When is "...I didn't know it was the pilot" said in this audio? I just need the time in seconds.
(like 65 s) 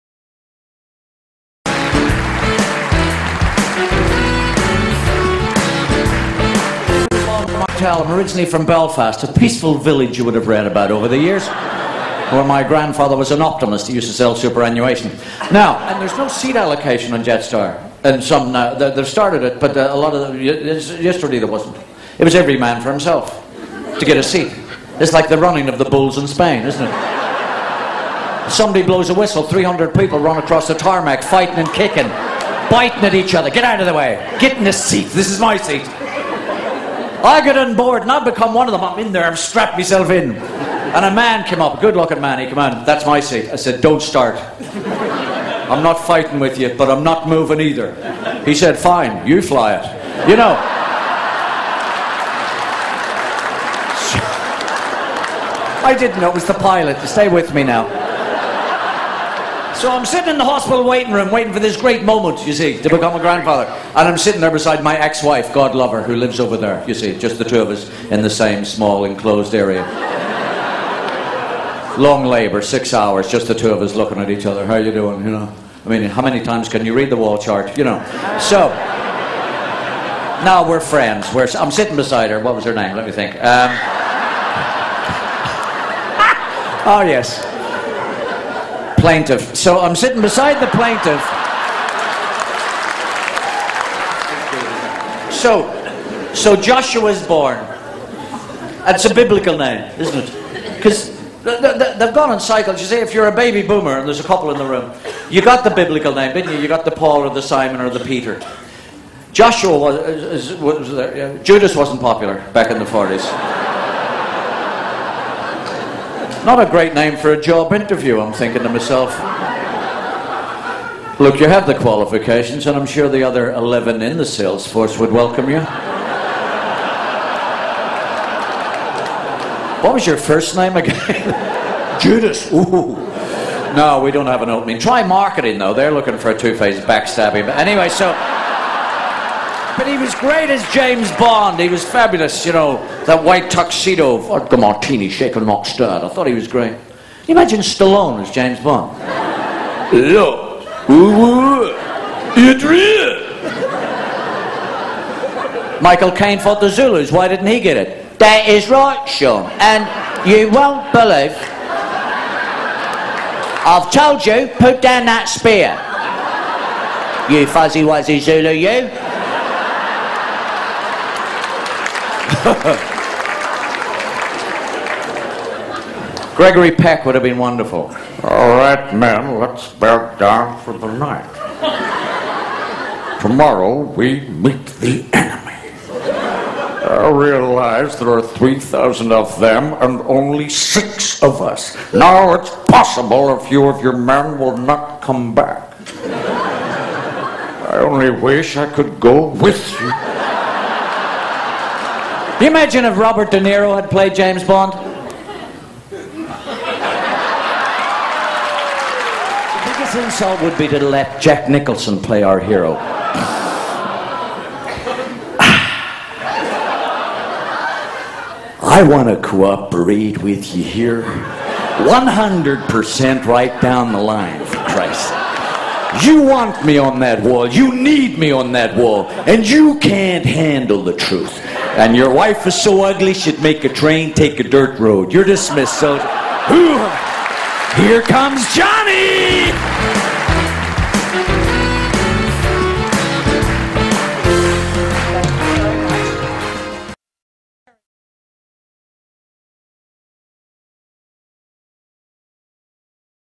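55 s.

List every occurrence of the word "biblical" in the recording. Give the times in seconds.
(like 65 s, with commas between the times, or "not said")
99 s, 105 s.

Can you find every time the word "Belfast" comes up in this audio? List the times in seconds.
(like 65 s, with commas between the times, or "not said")
8 s.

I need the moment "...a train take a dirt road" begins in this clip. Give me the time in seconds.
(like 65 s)
233 s.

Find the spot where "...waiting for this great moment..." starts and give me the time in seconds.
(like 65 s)
61 s.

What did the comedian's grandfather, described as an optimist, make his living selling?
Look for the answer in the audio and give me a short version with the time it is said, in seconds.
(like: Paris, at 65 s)
superannuation, at 14 s.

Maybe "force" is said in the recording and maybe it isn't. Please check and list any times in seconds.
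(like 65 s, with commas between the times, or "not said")
124 s.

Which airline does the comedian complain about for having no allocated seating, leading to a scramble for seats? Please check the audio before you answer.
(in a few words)
Jetstar.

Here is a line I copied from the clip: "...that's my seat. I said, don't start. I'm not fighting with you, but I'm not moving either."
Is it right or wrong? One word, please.
right.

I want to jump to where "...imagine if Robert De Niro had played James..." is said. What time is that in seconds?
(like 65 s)
202 s.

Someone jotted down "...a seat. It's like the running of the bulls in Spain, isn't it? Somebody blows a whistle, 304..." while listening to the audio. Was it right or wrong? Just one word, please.
wrong.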